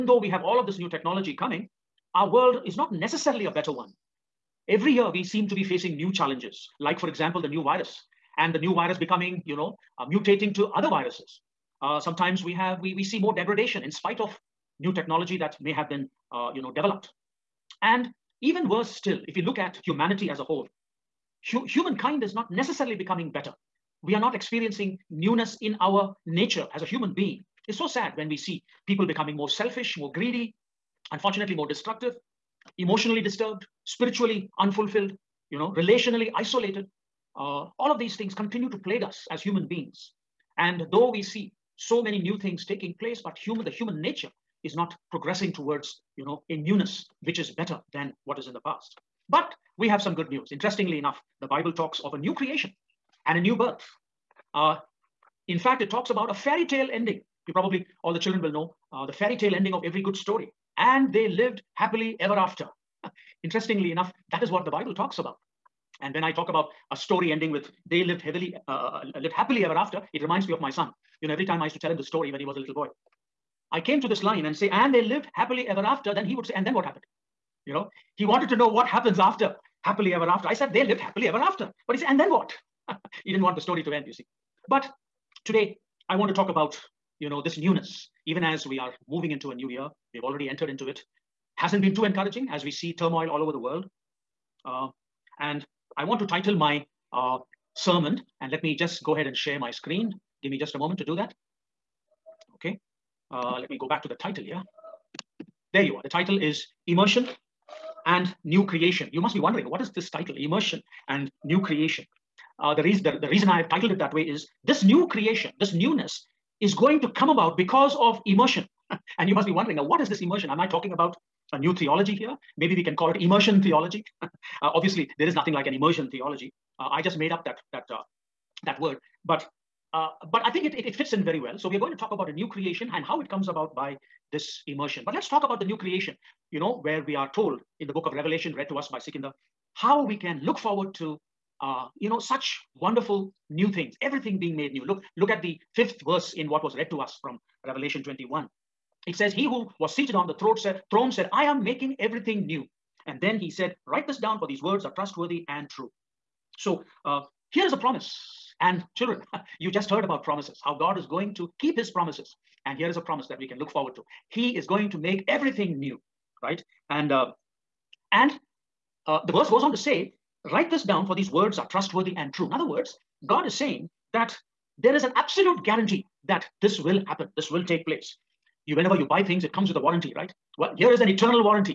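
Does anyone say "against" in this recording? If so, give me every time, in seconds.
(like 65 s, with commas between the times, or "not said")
not said.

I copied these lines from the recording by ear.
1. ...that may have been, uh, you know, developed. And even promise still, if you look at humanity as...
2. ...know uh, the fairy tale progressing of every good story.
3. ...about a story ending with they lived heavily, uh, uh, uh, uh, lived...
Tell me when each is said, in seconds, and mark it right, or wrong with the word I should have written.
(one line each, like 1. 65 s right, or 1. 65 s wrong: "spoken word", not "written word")
1. 15 s wrong: "worse", not "promise"
2. 58 s wrong: "ending", not "progressing"
3. 66 s right.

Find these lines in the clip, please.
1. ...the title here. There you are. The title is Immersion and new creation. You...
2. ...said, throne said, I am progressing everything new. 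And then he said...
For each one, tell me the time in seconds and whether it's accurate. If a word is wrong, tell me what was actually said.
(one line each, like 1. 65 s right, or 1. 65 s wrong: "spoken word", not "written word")
1. 104 s right
2. 150 s wrong: "making", not "progressing".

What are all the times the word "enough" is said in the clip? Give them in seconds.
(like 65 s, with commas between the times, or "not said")
50 s, 63 s.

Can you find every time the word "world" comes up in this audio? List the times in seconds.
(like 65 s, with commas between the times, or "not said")
2 s, 93 s.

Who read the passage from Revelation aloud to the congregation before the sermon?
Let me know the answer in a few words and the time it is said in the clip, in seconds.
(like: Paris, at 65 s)
Sikinda, at 138 s.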